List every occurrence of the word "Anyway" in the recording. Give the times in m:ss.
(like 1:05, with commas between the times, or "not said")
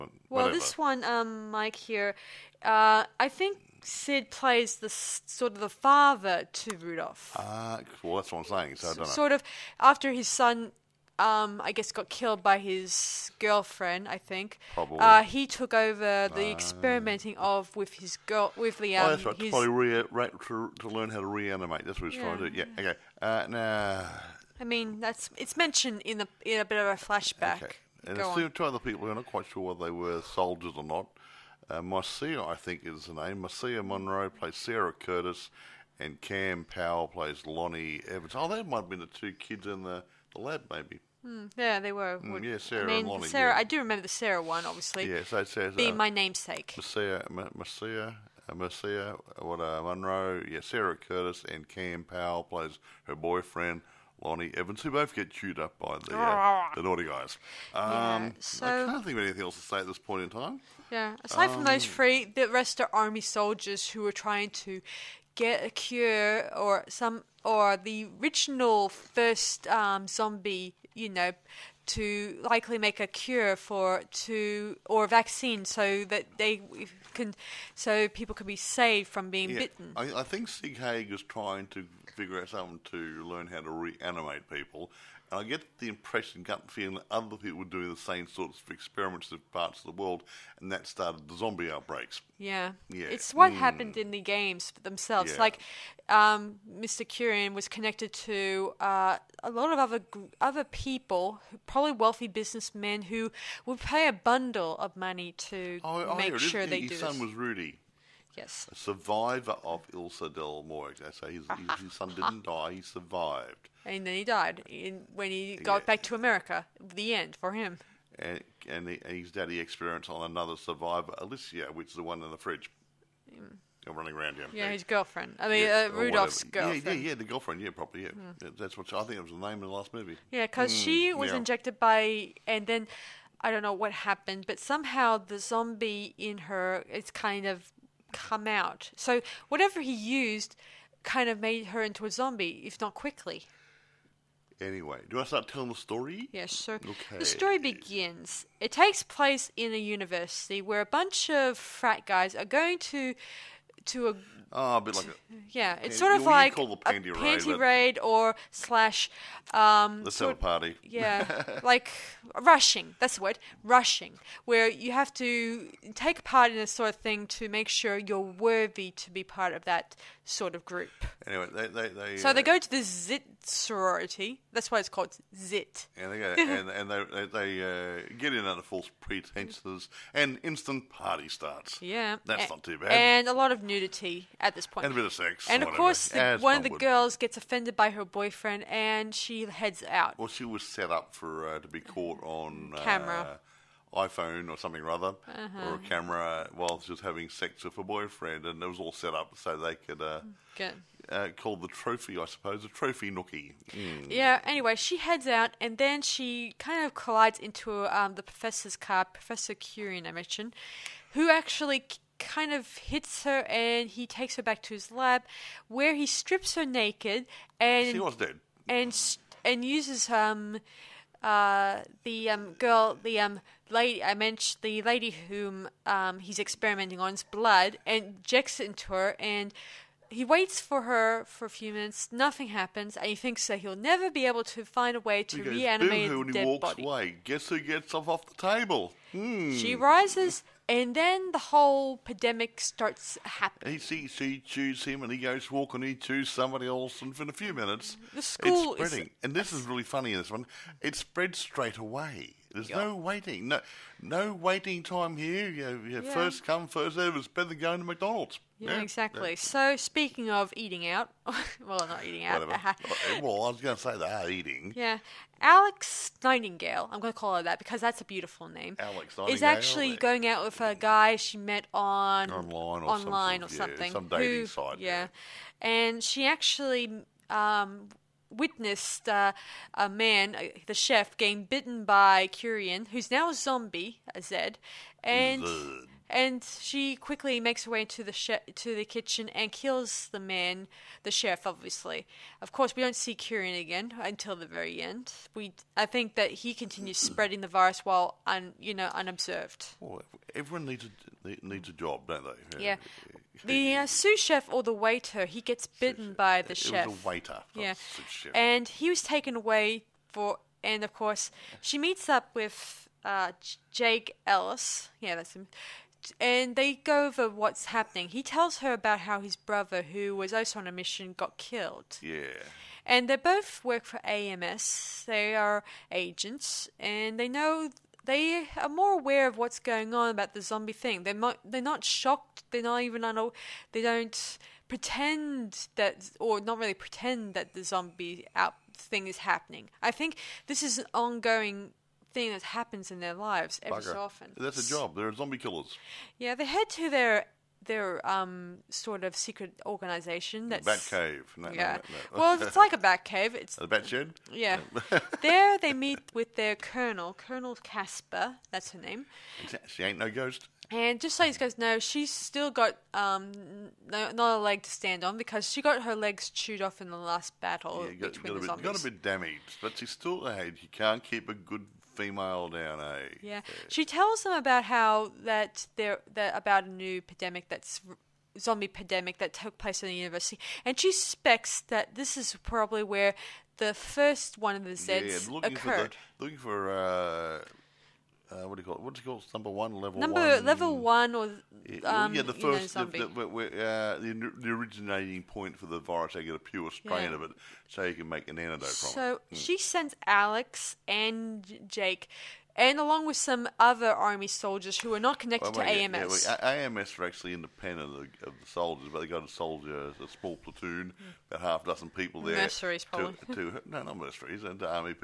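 2:24, 2:51, 3:24.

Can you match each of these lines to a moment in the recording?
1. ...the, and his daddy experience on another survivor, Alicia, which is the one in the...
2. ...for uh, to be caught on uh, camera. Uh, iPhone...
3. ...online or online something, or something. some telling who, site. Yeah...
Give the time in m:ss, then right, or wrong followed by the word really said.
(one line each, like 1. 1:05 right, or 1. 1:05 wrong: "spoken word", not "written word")
1. 1:58 right
2. 3:11 right
3. 4:32 wrong: "dating", not "telling".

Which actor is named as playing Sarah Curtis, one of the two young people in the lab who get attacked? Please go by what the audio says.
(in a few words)
Marcia Monroe.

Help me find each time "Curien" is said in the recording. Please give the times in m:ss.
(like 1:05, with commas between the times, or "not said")
1:37, 3:29, 4:42.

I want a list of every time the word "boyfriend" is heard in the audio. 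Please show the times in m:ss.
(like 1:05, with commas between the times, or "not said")
0:53, 3:08, 3:17.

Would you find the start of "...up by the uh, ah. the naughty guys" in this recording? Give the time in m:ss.
0:55.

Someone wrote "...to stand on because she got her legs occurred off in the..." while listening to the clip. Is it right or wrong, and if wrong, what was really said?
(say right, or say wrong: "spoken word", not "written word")
wrong: "chewed", not "occurred".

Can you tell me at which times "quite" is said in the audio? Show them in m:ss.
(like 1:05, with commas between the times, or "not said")
0:29.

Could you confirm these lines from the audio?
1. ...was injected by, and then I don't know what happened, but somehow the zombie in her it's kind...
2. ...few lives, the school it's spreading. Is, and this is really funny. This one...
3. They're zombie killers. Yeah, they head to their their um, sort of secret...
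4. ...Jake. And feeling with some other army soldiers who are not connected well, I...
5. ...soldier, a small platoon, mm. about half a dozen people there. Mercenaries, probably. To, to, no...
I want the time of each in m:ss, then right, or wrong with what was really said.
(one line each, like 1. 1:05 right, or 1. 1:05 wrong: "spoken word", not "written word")
1. 2:11 right
2. 4:07 wrong: "minutes", not "lives"
3. 5:44 right
4. 6:41 wrong: "along", not "feeling"
5. 6:49 right.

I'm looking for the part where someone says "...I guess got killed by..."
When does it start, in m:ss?
0:11.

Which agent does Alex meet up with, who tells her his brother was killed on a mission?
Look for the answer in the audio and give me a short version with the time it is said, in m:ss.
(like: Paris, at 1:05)
Jake Ellis, at 5:13.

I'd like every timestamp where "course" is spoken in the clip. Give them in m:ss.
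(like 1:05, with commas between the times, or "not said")
3:05, 4:52, 5:10.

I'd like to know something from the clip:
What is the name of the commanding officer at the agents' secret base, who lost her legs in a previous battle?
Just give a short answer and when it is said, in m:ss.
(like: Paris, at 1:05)
Colonel Casper, at 5:57.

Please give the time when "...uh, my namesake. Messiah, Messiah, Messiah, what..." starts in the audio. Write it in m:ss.
0:45.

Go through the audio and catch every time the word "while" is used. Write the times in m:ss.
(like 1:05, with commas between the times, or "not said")
3:16, 4:57.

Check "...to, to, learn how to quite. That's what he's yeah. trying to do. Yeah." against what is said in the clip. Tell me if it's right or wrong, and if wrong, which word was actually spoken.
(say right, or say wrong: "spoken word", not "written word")
wrong: "reanimate", not "quite".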